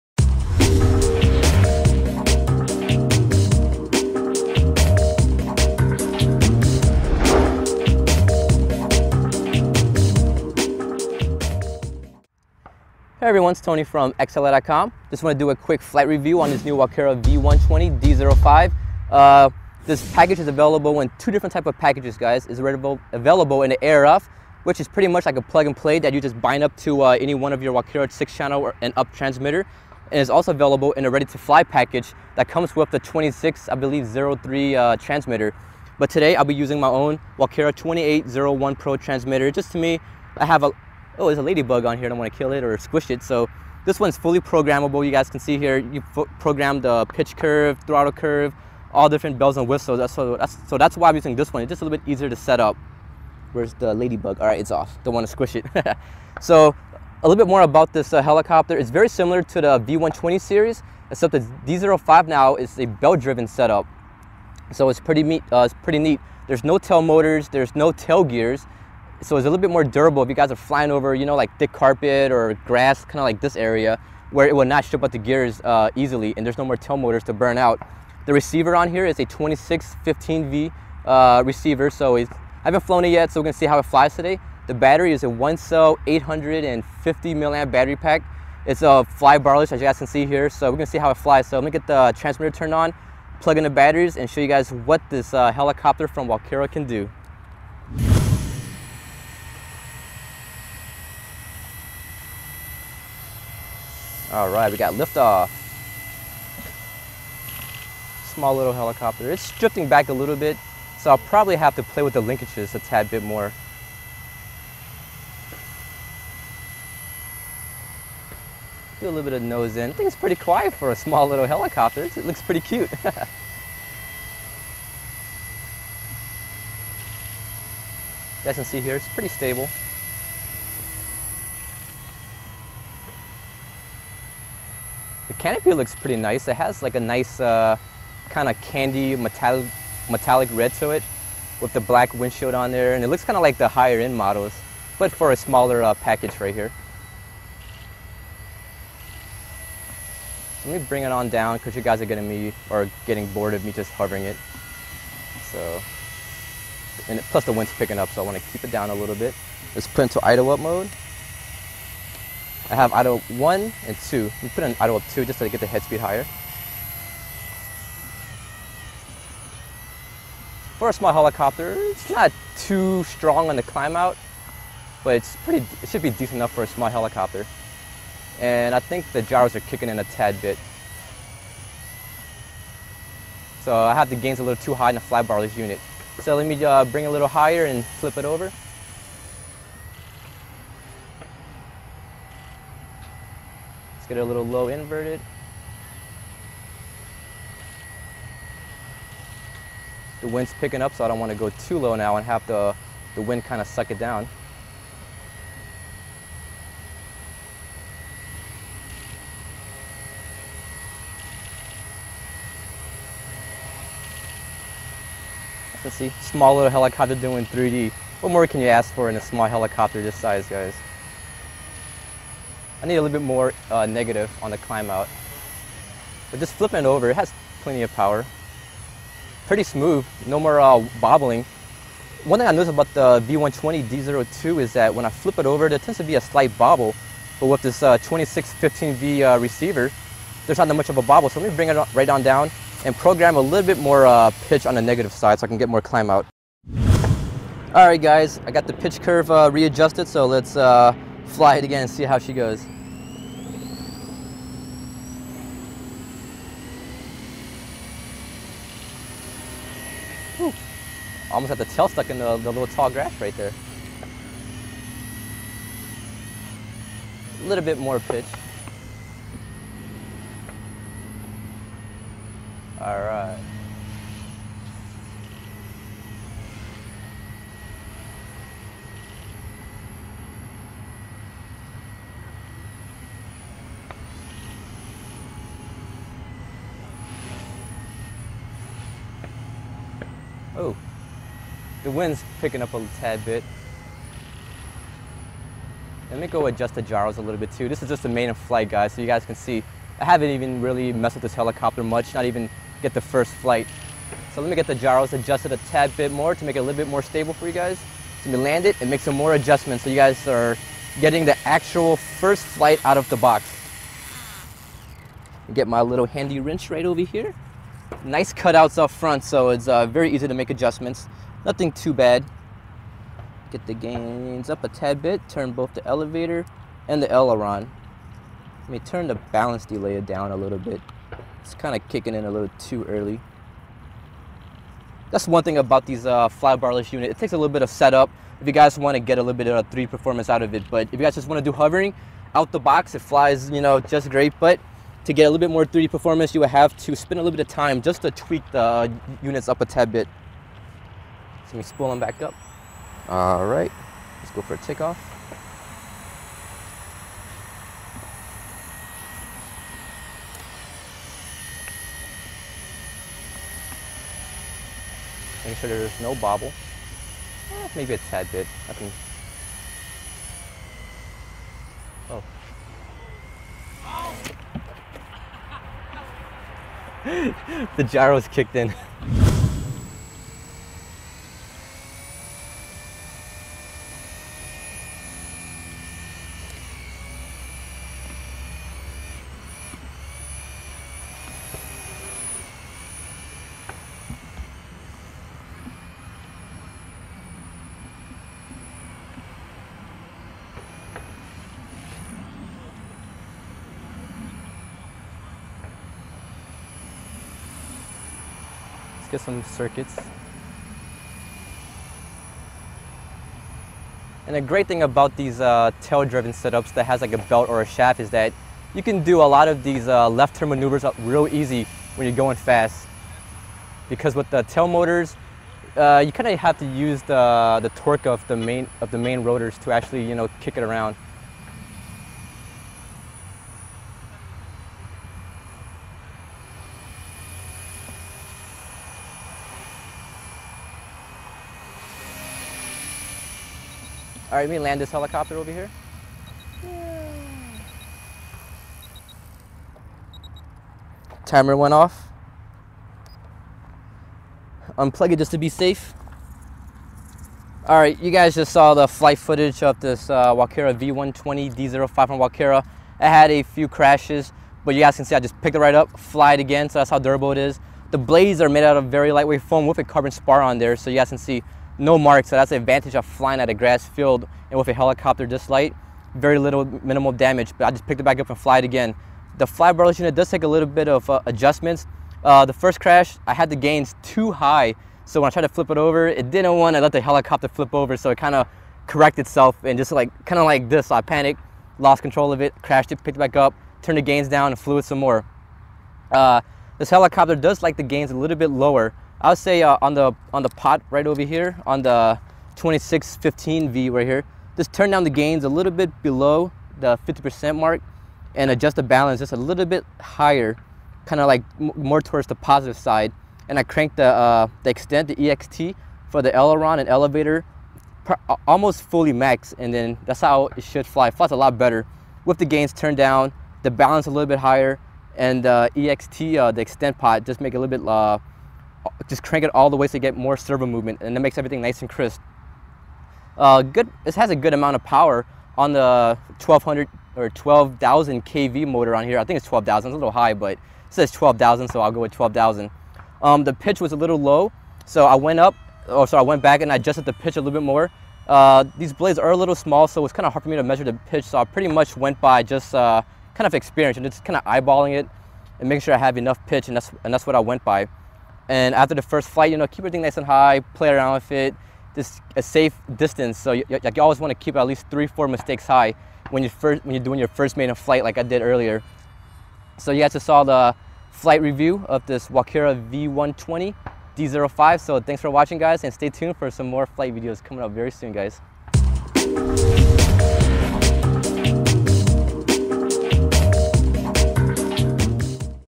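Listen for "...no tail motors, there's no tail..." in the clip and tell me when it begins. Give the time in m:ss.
1:06.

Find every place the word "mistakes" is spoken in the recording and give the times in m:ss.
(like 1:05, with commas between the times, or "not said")
9:25.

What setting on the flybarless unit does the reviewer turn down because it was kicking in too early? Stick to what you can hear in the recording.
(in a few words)
Balance delay.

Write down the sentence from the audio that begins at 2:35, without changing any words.
So, and plus the wind's picking up, so I want to keep it down a little bit.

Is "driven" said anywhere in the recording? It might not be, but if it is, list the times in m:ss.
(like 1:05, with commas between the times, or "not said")
1:02, 6:55.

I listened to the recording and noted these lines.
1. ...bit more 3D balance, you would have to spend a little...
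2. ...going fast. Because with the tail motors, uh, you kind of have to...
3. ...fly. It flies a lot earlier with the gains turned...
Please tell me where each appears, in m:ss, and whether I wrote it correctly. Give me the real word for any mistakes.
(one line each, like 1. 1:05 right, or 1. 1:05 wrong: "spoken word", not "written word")
1. 5:45 wrong: "performance", not "balance"
2. 7:02 right
3. 8:40 wrong: "better", not "earlier".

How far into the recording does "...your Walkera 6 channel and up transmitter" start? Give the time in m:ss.
0:27.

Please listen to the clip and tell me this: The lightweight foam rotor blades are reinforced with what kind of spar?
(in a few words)
Carbon spar.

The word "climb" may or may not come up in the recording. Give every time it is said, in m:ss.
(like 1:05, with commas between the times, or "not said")
2:53, 3:44, 4:05.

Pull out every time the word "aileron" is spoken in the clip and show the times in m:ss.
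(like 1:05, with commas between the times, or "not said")
5:27, 8:36.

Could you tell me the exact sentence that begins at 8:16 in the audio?
Uh, this helicopter does like the gains a little bit lower.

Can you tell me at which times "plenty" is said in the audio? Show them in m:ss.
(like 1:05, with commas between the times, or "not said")
3:47.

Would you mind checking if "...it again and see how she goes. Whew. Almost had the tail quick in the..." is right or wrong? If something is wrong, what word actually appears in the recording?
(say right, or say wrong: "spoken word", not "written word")
wrong: "stuck", not "quick".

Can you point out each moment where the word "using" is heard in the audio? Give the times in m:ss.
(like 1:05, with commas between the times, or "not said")
0:36, 0:51.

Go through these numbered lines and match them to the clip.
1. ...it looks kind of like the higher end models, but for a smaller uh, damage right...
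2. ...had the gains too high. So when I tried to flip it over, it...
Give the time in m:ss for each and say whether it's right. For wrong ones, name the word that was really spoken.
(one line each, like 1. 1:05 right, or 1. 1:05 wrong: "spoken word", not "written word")
1. 2:23 wrong: "package", not "damage"
2. 8:03 right.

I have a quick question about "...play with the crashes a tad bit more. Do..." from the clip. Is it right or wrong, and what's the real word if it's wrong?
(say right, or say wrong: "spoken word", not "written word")
wrong: "linkages", not "crashes".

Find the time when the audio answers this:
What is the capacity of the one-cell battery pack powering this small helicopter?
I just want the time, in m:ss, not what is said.
1:26.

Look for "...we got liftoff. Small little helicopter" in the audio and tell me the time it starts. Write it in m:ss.
1:44.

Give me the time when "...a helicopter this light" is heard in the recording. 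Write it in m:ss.
7:54.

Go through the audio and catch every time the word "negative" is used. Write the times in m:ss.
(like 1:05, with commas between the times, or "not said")
3:43, 4:04.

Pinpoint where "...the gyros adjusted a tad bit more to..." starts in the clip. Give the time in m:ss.
5:04.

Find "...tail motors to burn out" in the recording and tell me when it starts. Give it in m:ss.
1:16.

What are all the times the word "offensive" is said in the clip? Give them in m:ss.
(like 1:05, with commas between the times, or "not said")
not said.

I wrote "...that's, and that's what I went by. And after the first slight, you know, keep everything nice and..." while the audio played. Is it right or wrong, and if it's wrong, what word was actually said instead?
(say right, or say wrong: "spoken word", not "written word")
wrong: "flight", not "slight".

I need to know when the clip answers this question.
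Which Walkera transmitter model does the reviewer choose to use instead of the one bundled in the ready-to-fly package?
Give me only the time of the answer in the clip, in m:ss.
0:37.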